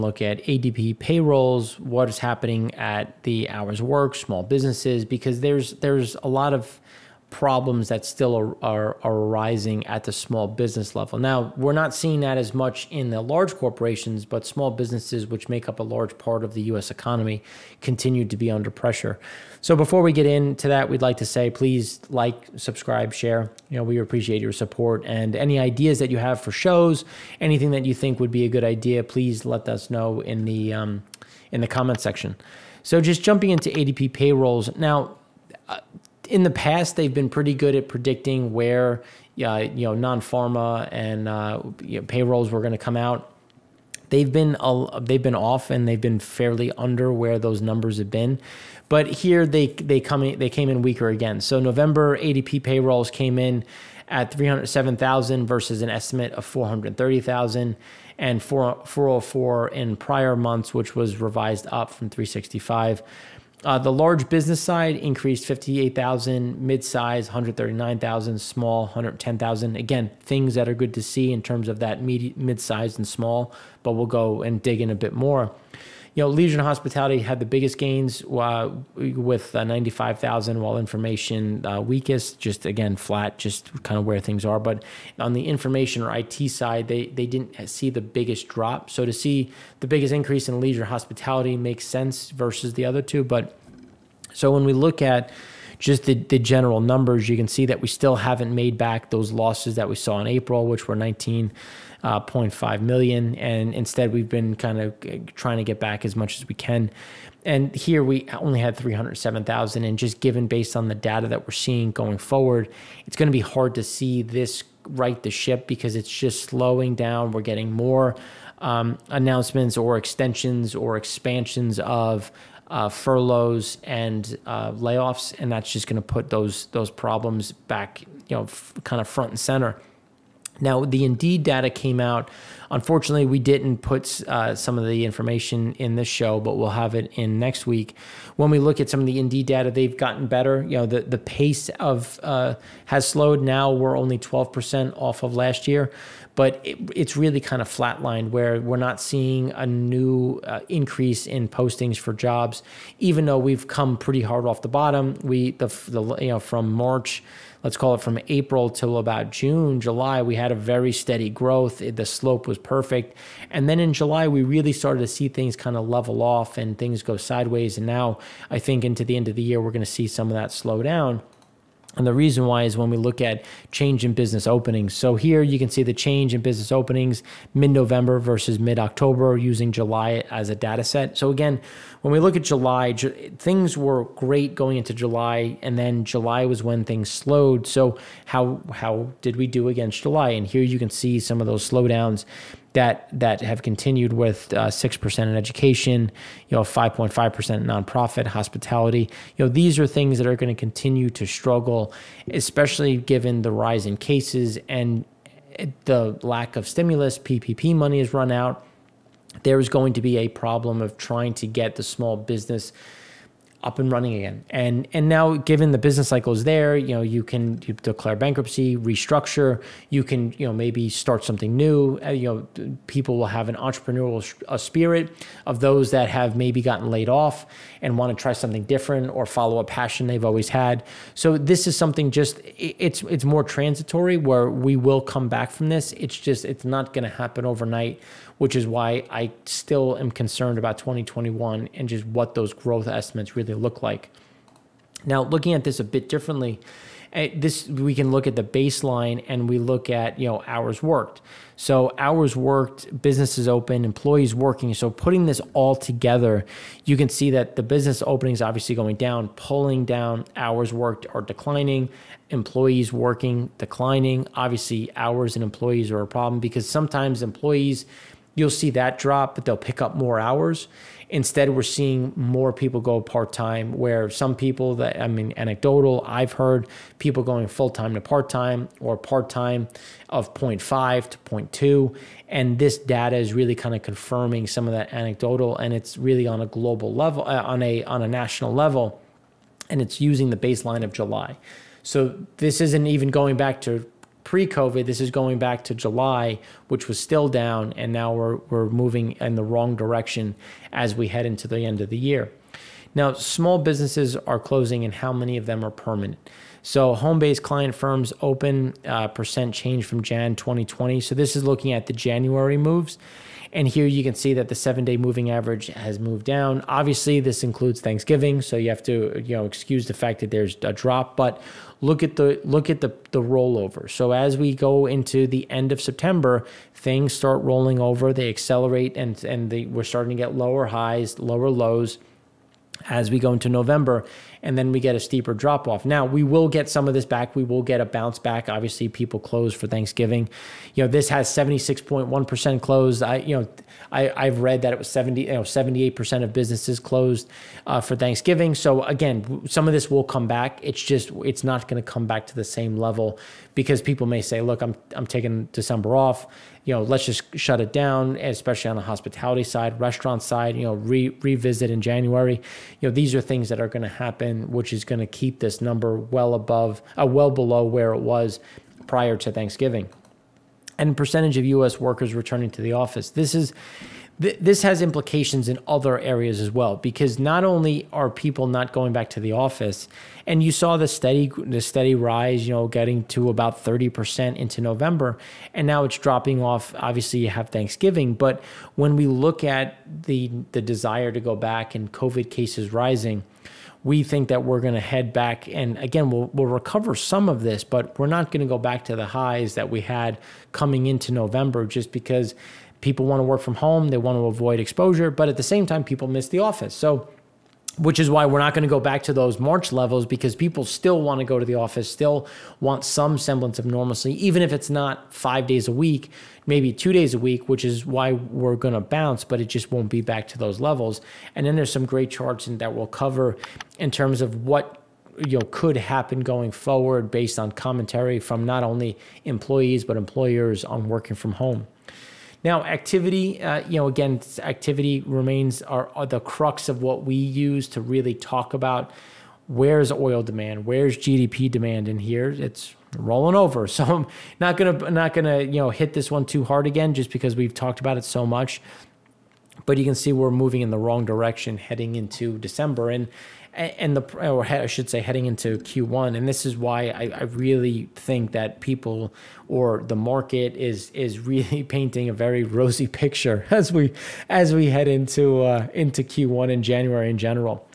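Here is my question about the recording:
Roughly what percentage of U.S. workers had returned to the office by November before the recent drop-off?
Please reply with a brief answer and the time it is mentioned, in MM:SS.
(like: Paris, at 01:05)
30%, at 06:23.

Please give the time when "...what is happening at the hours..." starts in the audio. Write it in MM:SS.
00:01.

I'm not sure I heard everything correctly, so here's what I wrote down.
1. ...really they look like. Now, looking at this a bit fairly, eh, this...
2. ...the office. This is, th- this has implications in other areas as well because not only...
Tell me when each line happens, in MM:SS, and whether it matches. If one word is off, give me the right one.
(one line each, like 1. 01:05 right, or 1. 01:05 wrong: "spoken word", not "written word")
1. 04:03 wrong: "differently", not "fairly"
2. 06:12 right.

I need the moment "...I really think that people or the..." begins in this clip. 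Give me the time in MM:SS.
07:37.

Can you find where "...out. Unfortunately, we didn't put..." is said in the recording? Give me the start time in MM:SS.
02:11.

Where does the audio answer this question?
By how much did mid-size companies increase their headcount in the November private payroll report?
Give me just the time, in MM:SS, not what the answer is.
01:07.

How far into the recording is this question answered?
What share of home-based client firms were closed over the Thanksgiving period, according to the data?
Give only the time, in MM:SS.
05:41.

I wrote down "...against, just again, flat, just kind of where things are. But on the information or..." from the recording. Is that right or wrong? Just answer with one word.
wrong.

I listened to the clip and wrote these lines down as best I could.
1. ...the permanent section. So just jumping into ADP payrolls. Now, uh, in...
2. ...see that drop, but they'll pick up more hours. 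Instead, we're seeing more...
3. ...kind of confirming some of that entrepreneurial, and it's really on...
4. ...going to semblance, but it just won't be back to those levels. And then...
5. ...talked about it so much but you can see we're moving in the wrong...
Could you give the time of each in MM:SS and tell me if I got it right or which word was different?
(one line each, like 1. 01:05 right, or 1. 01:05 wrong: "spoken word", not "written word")
1. 00:31 wrong: "comment", not "permanent"
2. 04:28 right
3. 04:43 wrong: "anecdotal", not "entrepreneurial"
4. 06:58 wrong: "bounce", not "semblance"
5. 07:27 right.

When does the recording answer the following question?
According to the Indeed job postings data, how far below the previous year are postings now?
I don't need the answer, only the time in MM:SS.
02:24.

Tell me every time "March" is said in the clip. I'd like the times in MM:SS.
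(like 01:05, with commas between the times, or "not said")
02:36, 06:49.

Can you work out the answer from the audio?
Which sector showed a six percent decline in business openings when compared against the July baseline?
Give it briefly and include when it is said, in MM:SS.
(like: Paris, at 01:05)
Education, at 03:15.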